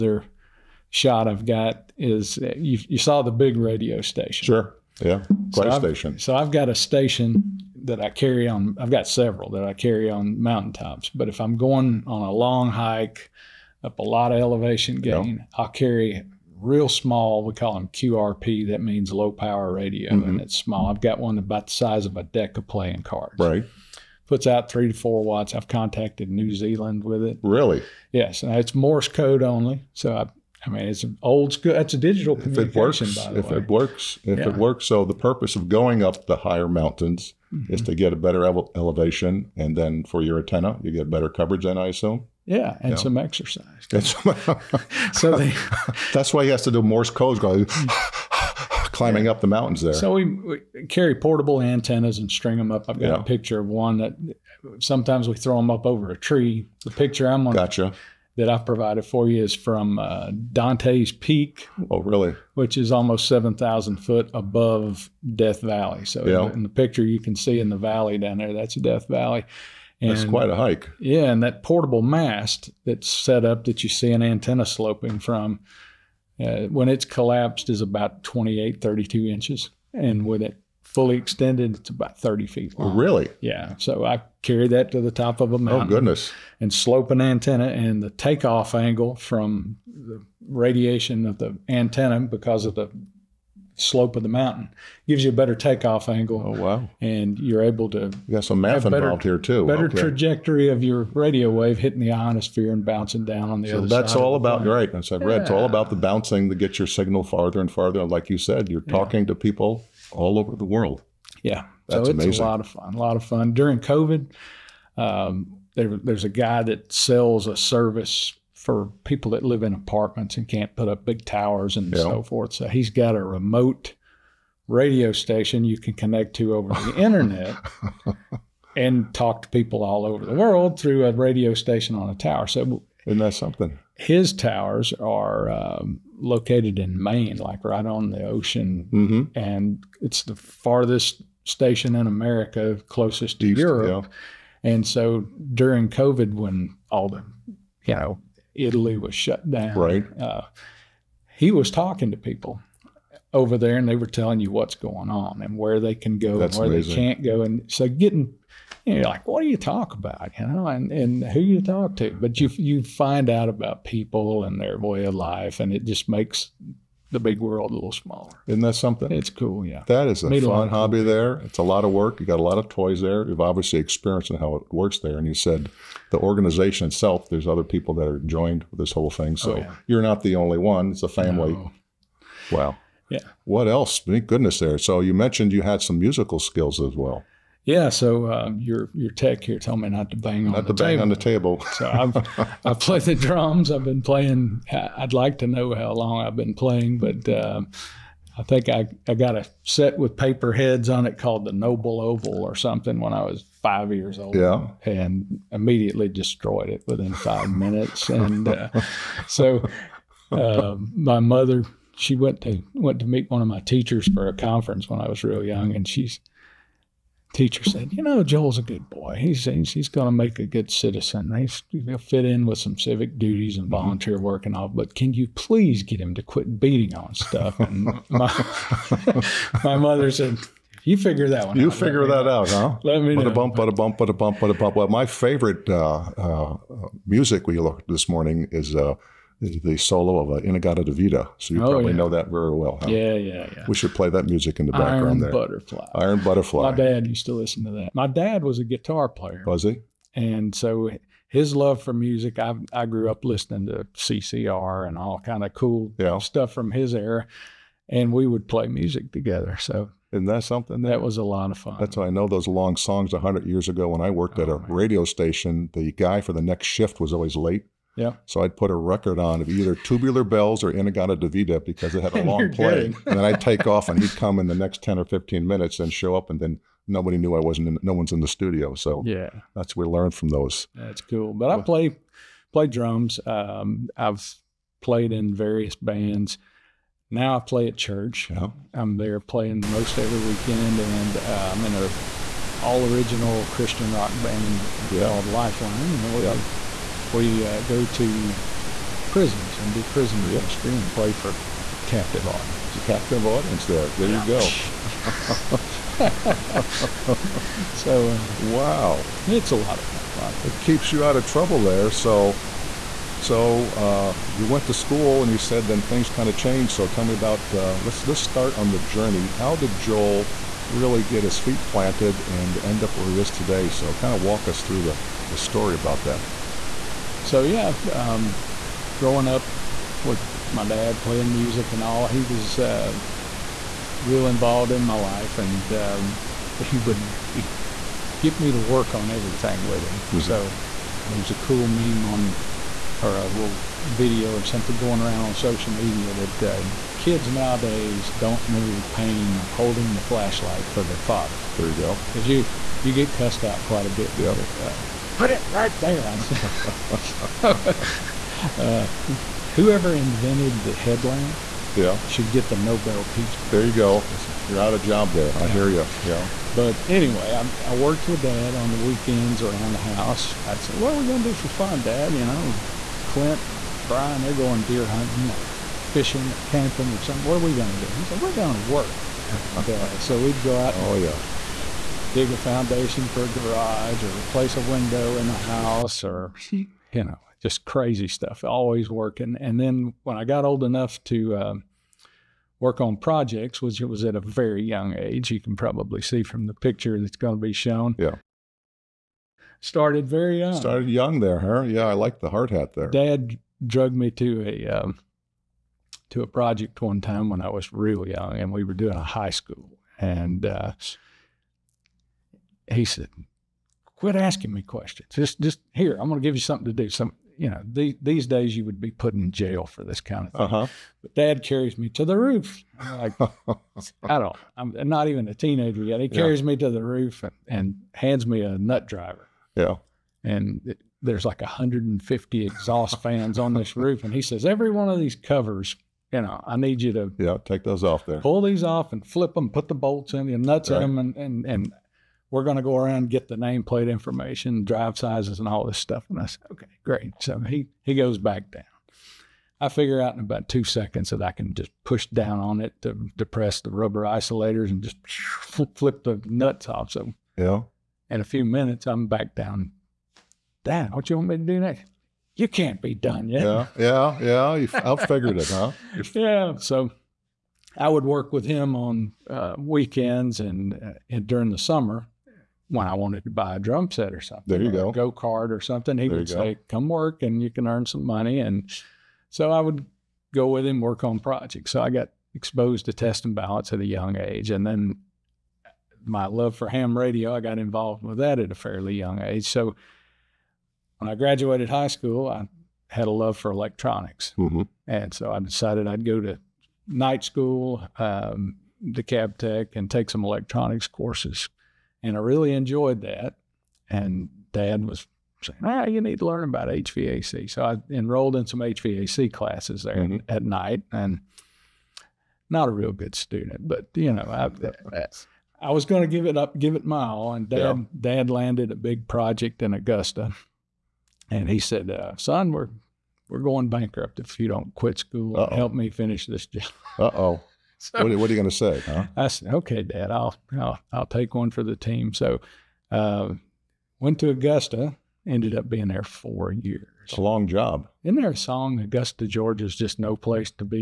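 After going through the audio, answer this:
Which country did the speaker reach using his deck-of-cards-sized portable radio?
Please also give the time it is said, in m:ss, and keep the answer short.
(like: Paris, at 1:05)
New Zealand, at 0:26.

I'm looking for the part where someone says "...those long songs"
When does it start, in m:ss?
4:22.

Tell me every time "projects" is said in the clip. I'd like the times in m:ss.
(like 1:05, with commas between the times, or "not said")
6:32, 6:46, 8:01, 8:39.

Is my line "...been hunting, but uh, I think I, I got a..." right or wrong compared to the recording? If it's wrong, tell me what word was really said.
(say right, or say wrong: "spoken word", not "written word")
wrong: "playing", not "hunting".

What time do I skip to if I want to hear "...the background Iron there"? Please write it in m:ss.
4:04.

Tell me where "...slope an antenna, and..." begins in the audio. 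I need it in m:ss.
1:26.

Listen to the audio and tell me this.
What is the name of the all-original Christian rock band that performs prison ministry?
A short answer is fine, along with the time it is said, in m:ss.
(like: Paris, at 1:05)
Lifeline, at 4:55.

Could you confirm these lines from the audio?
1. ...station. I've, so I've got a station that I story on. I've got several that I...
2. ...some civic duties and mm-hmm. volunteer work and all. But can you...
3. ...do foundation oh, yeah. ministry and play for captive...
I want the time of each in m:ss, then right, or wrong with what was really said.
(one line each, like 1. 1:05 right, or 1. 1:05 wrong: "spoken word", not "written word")
1. 0:05 wrong: "carry", not "story"
2. 3:42 right
3. 4:59 wrong: "prison", not "foundation".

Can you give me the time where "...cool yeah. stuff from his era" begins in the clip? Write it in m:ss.
4:15.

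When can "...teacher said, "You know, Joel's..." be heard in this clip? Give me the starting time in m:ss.
3:37.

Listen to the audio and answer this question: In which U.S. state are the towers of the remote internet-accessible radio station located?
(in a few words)
Maine.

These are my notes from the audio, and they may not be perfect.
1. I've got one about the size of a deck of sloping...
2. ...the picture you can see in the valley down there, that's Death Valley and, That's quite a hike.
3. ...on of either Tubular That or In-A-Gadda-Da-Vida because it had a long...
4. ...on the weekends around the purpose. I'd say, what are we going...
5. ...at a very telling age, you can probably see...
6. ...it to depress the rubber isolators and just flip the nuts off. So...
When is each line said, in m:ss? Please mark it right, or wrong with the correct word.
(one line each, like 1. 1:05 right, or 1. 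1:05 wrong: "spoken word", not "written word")
1. 0:20 wrong: "playing", not "sloping"
2. 1:06 right
3. 4:29 wrong: "Bells", not "That"
4. 6:08 wrong: "house", not "purpose"
5. 6:34 wrong: "young", not "telling"
6. 7:32 right.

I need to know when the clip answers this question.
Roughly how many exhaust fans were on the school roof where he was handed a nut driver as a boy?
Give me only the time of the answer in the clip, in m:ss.
7:11.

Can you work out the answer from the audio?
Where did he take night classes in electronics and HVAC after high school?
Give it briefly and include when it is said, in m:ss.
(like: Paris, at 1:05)
DeKalb Tech, at 8:18.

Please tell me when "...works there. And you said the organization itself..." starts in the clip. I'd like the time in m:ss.
2:54.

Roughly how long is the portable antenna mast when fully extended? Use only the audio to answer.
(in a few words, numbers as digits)
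30 feet.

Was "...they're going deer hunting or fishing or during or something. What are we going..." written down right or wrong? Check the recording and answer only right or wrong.
wrong.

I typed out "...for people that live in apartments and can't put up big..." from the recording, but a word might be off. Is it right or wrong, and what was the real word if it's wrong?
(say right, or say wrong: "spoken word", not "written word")
right.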